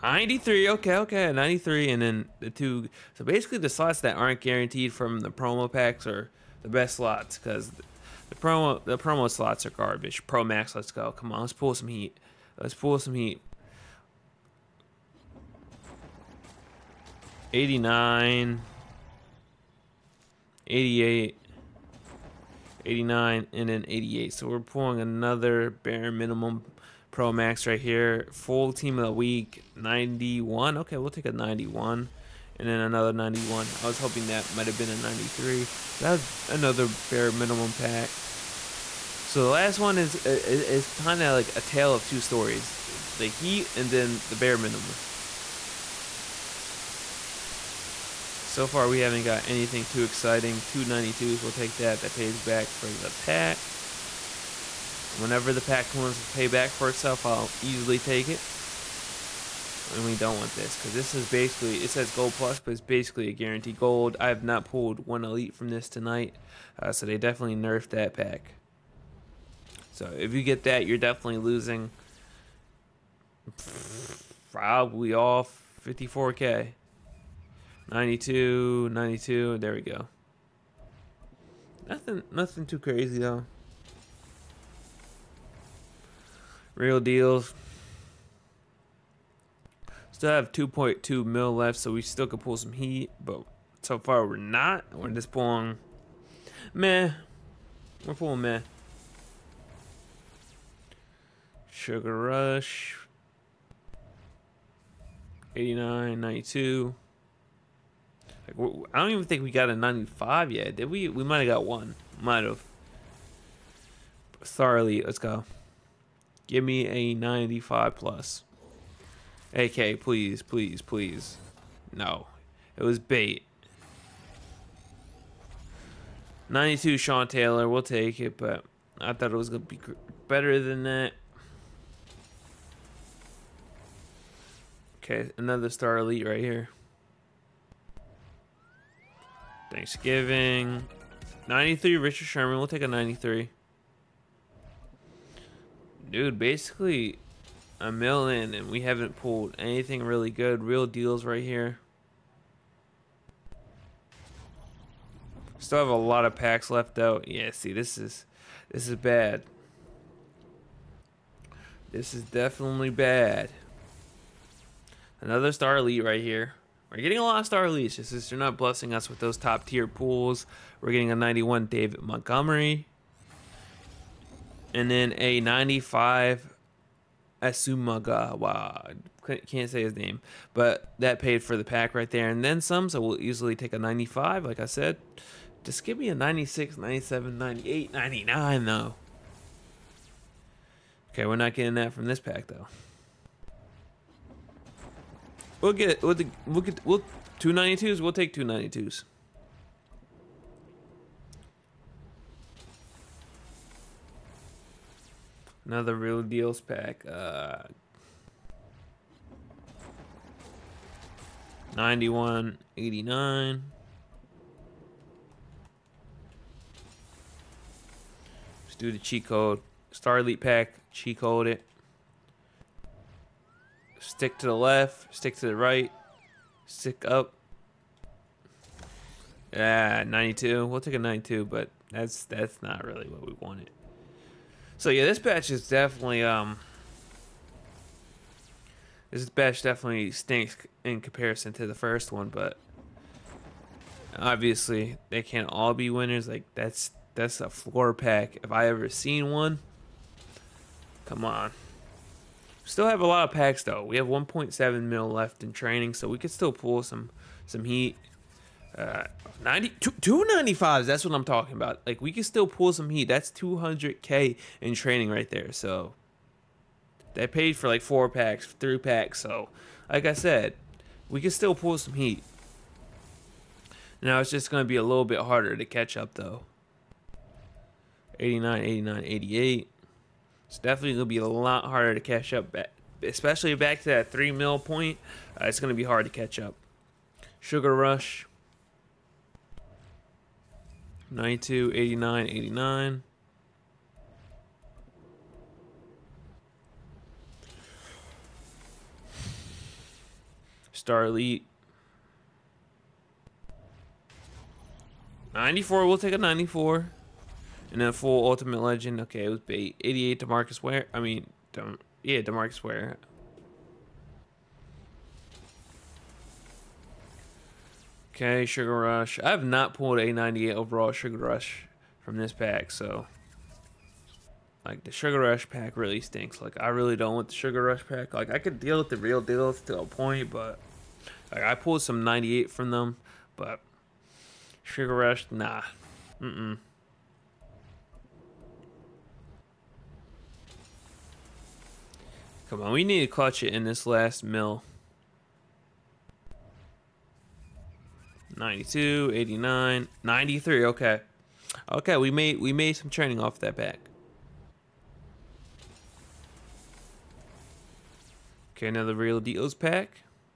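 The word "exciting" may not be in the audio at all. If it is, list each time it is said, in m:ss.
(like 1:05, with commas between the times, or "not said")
0:50.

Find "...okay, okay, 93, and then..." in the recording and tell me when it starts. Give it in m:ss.
0:00.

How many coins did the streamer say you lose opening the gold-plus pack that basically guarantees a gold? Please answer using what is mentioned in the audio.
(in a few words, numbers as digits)
54K.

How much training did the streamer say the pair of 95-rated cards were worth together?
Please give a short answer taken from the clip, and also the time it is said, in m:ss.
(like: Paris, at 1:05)
200K, at 4:23.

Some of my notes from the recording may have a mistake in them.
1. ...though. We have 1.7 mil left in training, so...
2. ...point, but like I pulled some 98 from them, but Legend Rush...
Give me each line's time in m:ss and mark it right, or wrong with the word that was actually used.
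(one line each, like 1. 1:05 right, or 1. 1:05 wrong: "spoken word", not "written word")
1. 4:13 right
2. 5:29 wrong: "Sugar", not "Legend".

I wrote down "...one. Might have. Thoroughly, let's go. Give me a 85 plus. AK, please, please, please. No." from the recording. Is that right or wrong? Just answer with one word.
wrong.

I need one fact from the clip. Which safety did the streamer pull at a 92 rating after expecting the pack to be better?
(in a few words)
Sean Taylor.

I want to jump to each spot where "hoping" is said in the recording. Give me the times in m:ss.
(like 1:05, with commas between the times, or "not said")
0:33.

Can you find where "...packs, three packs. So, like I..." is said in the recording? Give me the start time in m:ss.
4:28.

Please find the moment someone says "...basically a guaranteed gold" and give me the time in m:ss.
1:02.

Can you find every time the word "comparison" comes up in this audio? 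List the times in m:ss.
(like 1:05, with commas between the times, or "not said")
4:01.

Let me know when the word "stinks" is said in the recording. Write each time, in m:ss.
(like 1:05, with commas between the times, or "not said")
4:00, 5:26.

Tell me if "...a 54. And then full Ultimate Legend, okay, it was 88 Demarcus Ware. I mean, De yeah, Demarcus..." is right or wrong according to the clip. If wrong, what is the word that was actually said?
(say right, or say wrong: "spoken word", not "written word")
wrong: "94", not "54".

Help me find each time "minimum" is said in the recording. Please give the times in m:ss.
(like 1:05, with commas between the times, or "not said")
0:26, 0:37, 0:44.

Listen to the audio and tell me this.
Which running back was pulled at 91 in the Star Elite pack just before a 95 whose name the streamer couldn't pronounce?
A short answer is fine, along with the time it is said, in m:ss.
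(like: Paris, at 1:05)
David Montgomery, at 2:51.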